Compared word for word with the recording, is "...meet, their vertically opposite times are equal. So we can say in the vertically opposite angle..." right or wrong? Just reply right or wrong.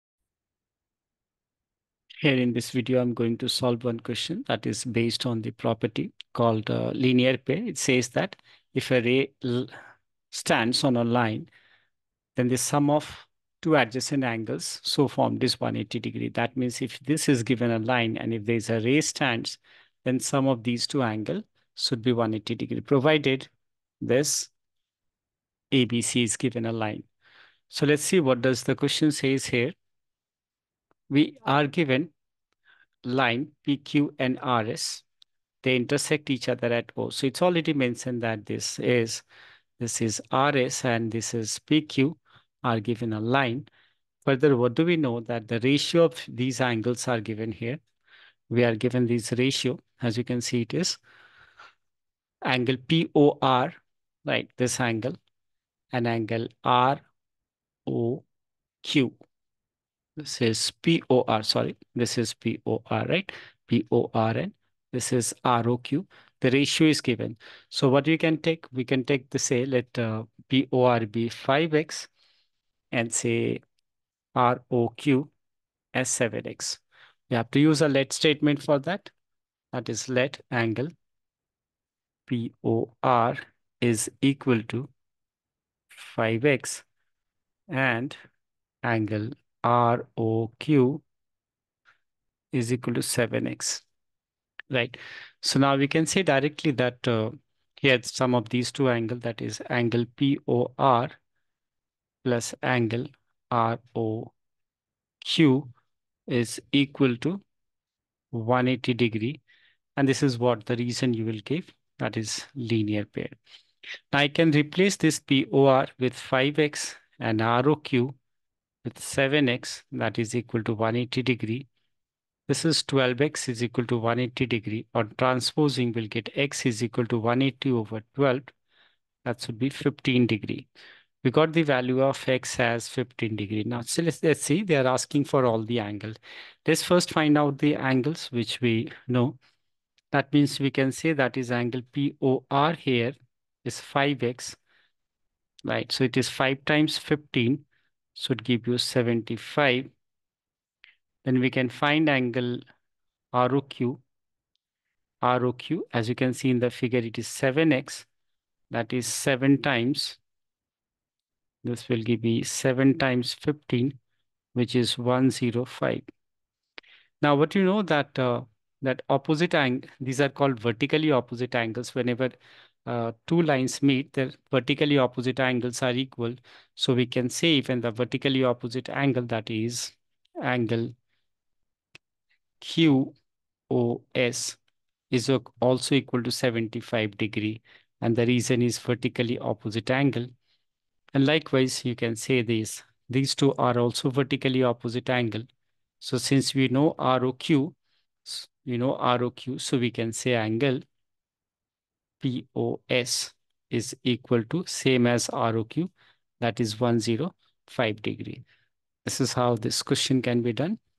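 wrong.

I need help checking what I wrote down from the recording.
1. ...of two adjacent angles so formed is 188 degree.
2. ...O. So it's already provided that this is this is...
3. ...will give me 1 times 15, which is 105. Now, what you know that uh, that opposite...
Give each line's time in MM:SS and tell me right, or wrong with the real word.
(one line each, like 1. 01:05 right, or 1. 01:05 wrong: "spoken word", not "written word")
1. 00:12 wrong: "180", not "188"
2. 00:36 wrong: "mentioned", not "provided"
3. 02:41 wrong: "7", not "1".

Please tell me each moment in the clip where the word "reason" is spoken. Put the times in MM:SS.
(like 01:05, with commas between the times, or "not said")
01:50, 03:08.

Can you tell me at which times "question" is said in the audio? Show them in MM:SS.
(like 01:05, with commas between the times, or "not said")
00:03, 00:28, 03:29.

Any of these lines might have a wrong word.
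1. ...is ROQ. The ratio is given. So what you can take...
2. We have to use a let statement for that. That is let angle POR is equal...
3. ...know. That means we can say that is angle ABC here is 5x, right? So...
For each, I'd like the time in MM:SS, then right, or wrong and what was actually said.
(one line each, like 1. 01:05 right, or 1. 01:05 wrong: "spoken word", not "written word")
1. 01:05 right
2. 01:17 right
3. 02:19 wrong: "POR", not "ABC".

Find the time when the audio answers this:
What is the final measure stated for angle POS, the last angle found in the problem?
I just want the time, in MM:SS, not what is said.
03:26.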